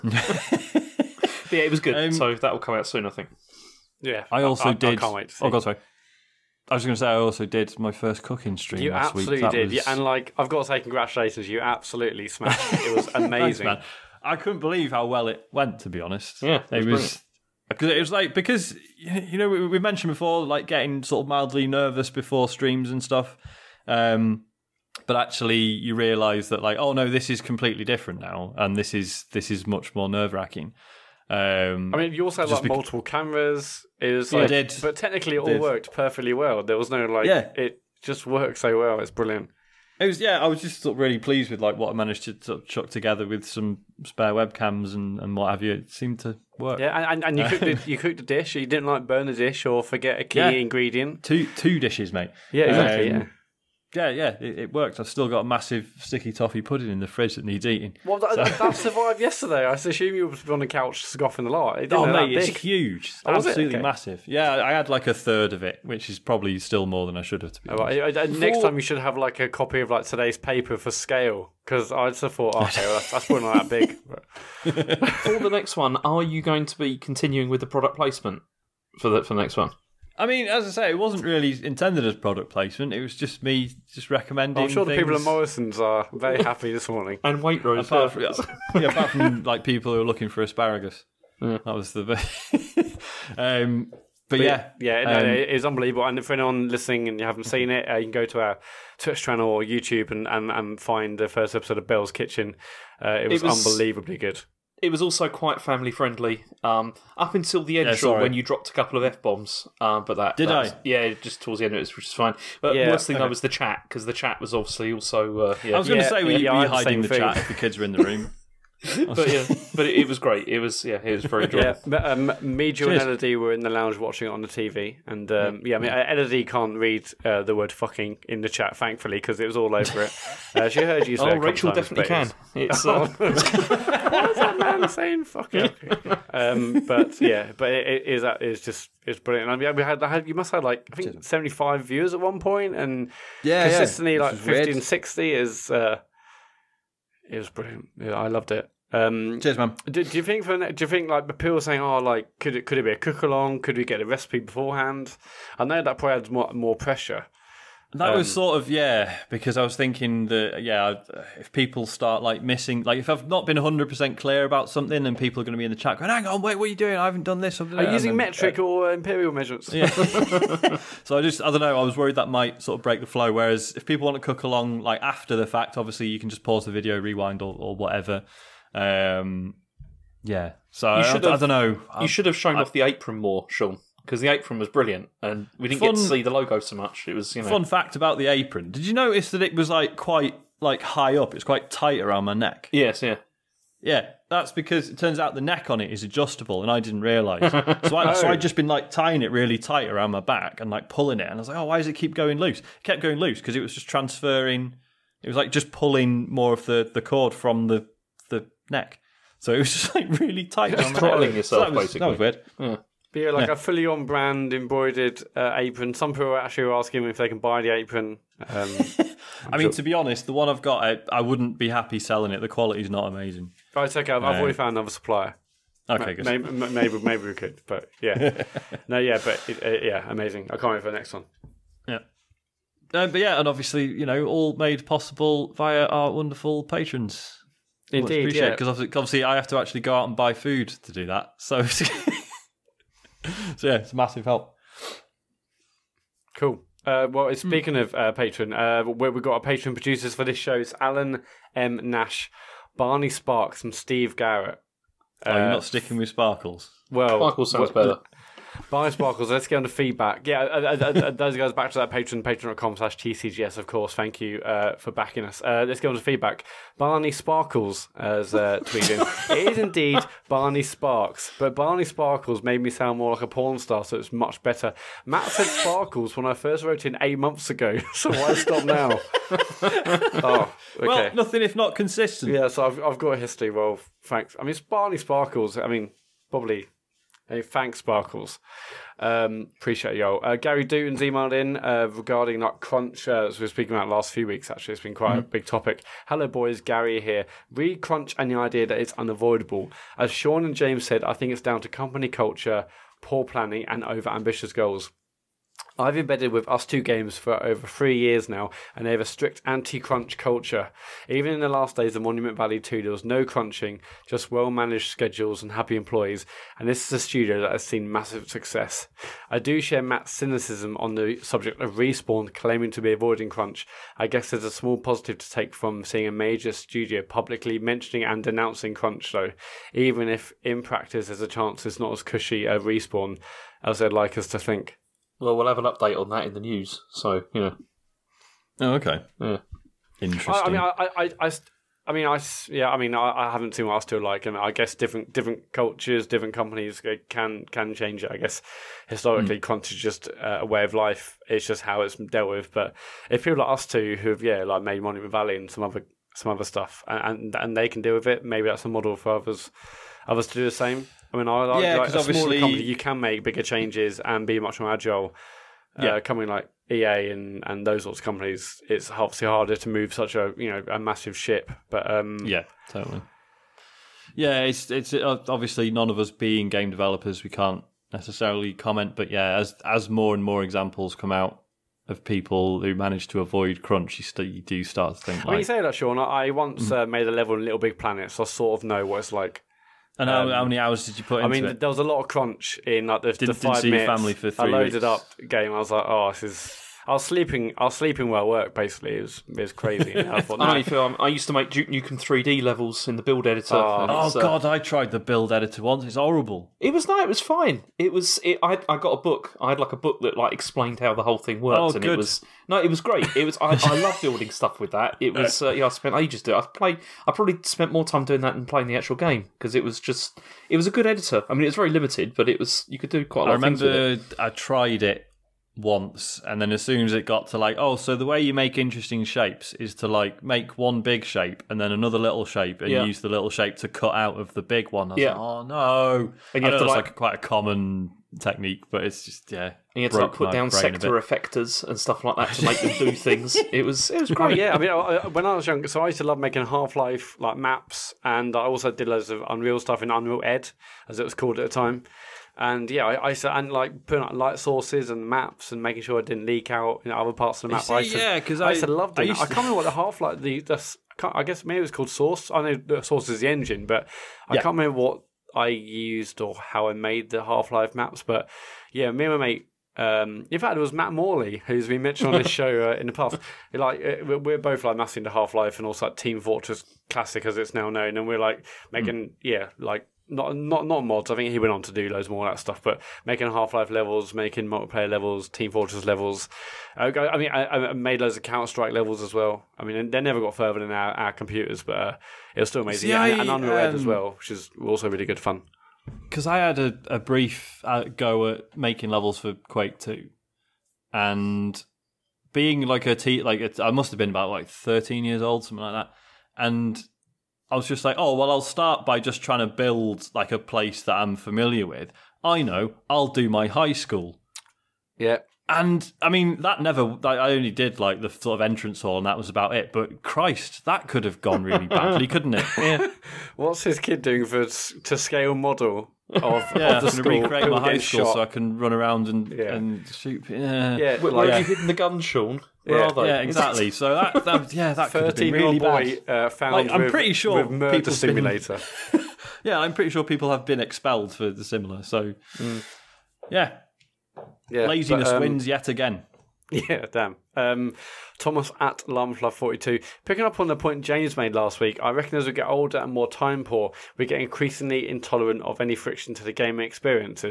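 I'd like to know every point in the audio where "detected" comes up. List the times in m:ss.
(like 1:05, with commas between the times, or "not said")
not said.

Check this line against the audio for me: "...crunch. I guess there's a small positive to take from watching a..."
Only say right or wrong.
wrong.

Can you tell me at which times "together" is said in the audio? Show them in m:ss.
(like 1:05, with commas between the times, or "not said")
0:42.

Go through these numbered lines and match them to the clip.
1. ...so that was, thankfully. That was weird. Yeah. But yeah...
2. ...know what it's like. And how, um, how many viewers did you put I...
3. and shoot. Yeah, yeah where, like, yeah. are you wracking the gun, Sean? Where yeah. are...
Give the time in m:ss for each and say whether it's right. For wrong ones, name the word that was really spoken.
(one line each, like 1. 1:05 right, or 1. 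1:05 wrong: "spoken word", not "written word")
1. 3:31 wrong: "basically", not "thankfully"
2. 6:28 wrong: "hours", not "viewers"
3. 8:49 wrong: "hitting", not "wracking".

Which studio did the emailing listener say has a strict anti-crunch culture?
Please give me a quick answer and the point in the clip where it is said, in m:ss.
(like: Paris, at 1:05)
ustwo games, at 5:06.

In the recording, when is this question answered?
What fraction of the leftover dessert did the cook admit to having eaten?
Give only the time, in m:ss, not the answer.
1:05.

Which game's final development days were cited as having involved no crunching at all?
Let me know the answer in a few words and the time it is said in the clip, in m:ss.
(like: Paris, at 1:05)
Monument Valley 2, at 5:12.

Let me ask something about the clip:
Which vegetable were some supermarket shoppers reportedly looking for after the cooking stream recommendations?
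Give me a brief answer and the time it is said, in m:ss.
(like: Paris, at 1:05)
Asparagus, at 1:30.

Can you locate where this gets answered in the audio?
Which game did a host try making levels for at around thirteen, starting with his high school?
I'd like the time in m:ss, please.
8:19.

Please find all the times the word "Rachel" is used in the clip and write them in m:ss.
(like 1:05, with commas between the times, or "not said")
2:11.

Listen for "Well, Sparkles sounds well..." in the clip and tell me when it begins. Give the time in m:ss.
4:16.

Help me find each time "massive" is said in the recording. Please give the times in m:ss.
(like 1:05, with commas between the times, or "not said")
0:55, 1:03, 4:03, 5:17, 6:10, 7:54.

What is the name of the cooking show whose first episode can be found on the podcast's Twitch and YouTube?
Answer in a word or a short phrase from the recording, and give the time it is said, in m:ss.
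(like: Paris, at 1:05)
Bell's Kitchen, at 1:41.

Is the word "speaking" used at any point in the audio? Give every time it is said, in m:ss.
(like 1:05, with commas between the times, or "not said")
4:07, 4:53.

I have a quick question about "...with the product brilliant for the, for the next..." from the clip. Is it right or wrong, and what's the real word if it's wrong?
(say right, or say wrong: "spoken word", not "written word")
wrong: "placement", not "brilliant".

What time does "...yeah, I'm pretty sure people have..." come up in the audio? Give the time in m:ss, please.
8:59.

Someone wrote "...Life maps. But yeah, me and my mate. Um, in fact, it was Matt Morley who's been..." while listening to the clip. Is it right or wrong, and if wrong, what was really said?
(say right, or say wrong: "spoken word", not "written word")
right.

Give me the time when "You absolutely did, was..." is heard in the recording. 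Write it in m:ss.
0:08.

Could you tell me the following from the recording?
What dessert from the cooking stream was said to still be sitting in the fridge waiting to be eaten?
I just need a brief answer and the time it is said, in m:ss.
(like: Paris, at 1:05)
Sticky toffee pudding, at 0:55.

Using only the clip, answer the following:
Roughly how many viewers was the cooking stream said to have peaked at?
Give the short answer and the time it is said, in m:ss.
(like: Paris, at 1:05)
75, at 2:21.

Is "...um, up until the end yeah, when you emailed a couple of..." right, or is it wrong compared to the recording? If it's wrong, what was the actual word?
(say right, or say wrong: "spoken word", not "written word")
wrong: "dropped", not "emailed".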